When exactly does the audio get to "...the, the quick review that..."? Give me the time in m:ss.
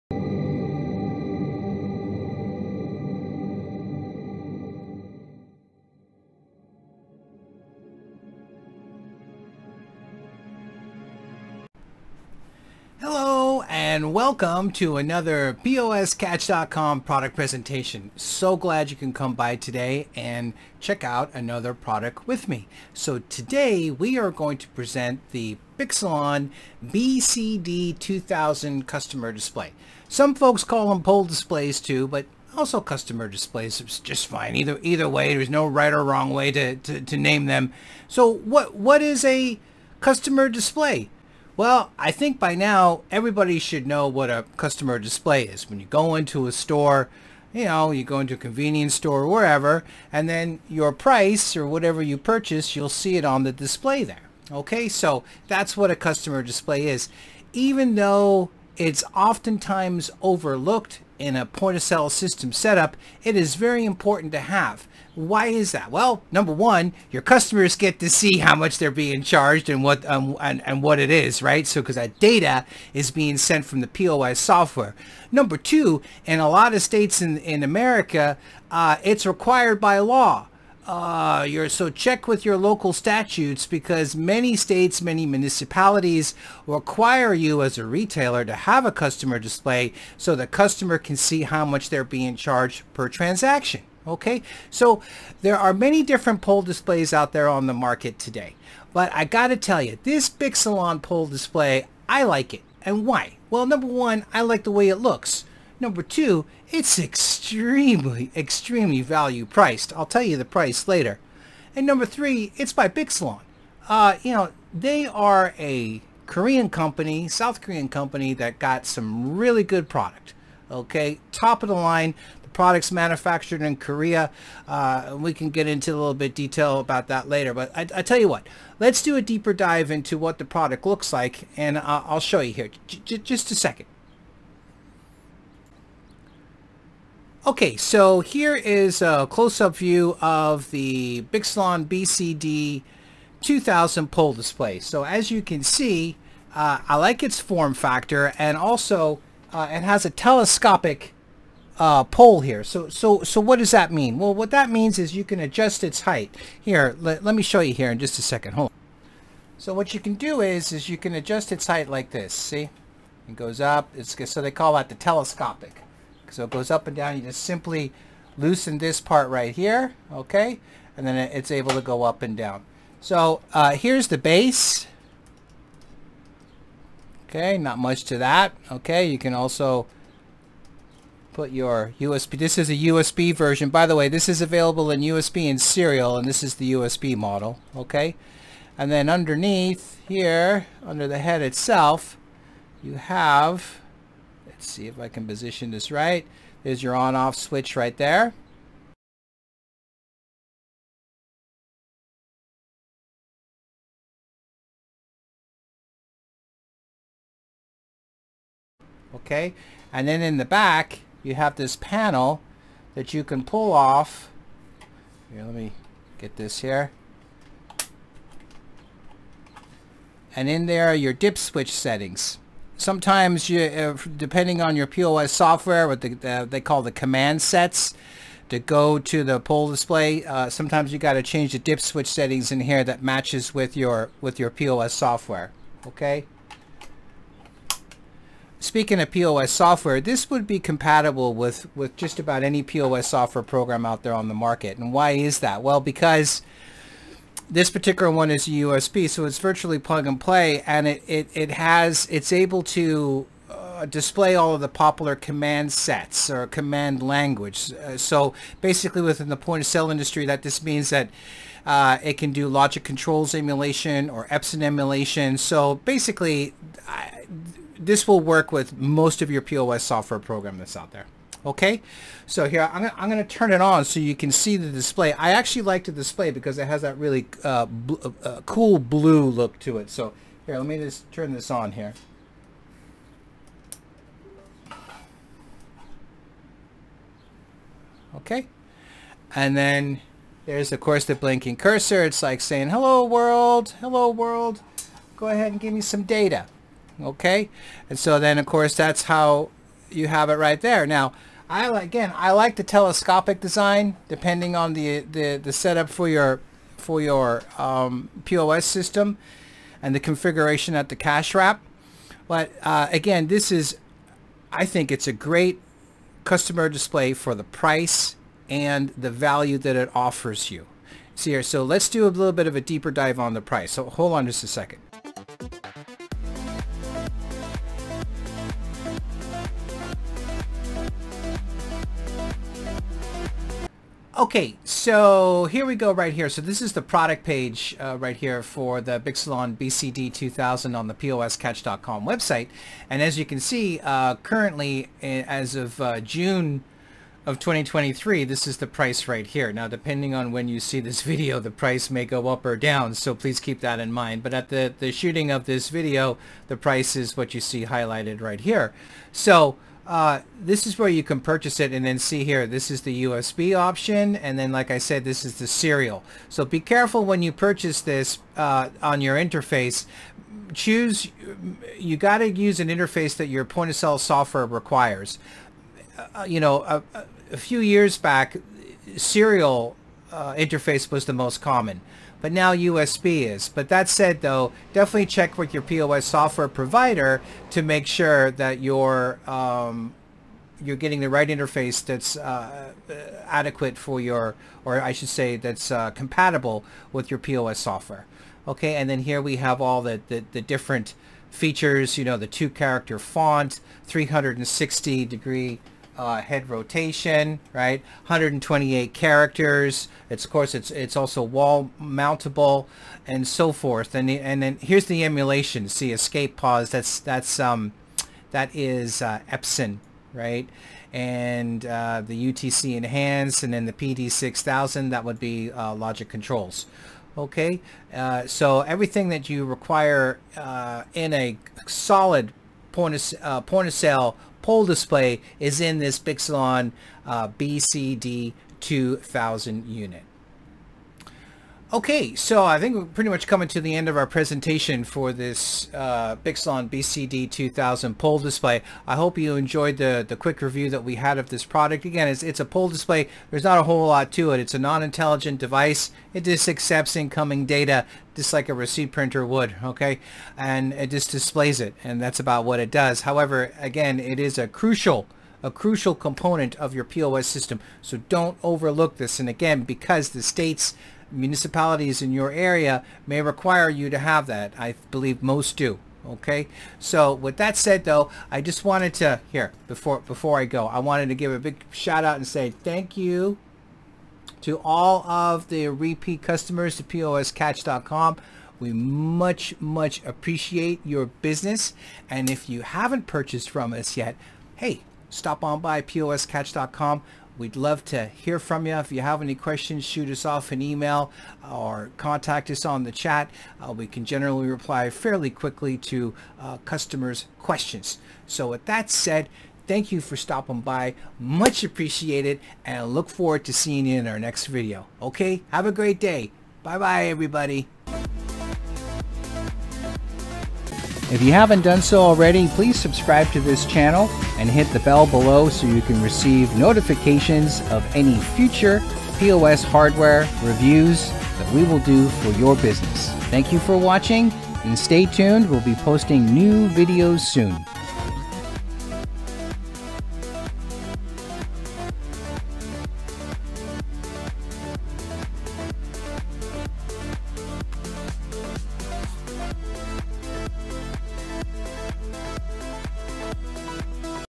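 7:29.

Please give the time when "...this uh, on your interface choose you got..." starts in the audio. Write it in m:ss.
6:07.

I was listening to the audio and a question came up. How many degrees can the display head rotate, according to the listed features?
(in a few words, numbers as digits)
360.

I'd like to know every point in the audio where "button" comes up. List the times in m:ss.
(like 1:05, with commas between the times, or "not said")
not said.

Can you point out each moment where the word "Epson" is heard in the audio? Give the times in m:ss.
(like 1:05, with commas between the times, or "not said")
4:24, 6:59.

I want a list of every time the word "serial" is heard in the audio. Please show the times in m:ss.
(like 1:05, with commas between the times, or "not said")
3:05, 6:05, 6:18.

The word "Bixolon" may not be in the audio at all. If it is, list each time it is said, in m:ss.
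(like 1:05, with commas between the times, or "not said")
0:25, 1:40, 1:52, 2:21, 5:38, 7:15, 7:26.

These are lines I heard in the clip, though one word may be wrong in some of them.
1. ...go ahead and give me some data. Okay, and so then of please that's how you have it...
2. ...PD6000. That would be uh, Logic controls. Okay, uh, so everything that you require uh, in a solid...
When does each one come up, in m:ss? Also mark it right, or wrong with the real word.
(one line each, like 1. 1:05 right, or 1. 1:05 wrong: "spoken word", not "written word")
1. 4:55 wrong: "course", not "please"
2. 7:03 right.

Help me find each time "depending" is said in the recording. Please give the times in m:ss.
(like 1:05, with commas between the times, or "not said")
3:44, 5:04, 5:49.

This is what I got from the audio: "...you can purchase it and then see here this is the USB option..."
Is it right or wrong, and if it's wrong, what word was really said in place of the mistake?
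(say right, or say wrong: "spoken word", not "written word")
right.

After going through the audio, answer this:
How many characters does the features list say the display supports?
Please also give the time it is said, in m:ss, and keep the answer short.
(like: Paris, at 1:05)
128, at 6:48.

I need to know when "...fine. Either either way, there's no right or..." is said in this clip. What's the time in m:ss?
0:34.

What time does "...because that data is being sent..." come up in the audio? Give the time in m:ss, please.
1:11.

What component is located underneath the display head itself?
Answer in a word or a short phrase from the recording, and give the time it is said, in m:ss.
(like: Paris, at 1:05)
on-off switch, at 3:16.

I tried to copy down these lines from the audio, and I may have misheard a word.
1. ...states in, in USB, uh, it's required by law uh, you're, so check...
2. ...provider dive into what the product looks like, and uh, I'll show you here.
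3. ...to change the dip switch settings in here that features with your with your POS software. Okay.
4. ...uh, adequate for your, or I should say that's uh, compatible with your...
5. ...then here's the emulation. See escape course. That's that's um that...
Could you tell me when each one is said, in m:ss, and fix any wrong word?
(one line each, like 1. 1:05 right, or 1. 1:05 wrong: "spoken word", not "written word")
1. 1:16 wrong: "America", not "USB"
2. 2:09 wrong: "deeper", not "provider"
3. 3:51 wrong: "matches", not "features"
4. 6:32 right
5. 6:54 wrong: "pause", not "course".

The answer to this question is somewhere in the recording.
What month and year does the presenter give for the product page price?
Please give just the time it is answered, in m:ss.
5:46.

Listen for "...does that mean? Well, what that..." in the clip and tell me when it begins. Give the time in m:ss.
2:33.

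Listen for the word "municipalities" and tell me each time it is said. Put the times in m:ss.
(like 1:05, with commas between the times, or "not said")
1:25, 7:51.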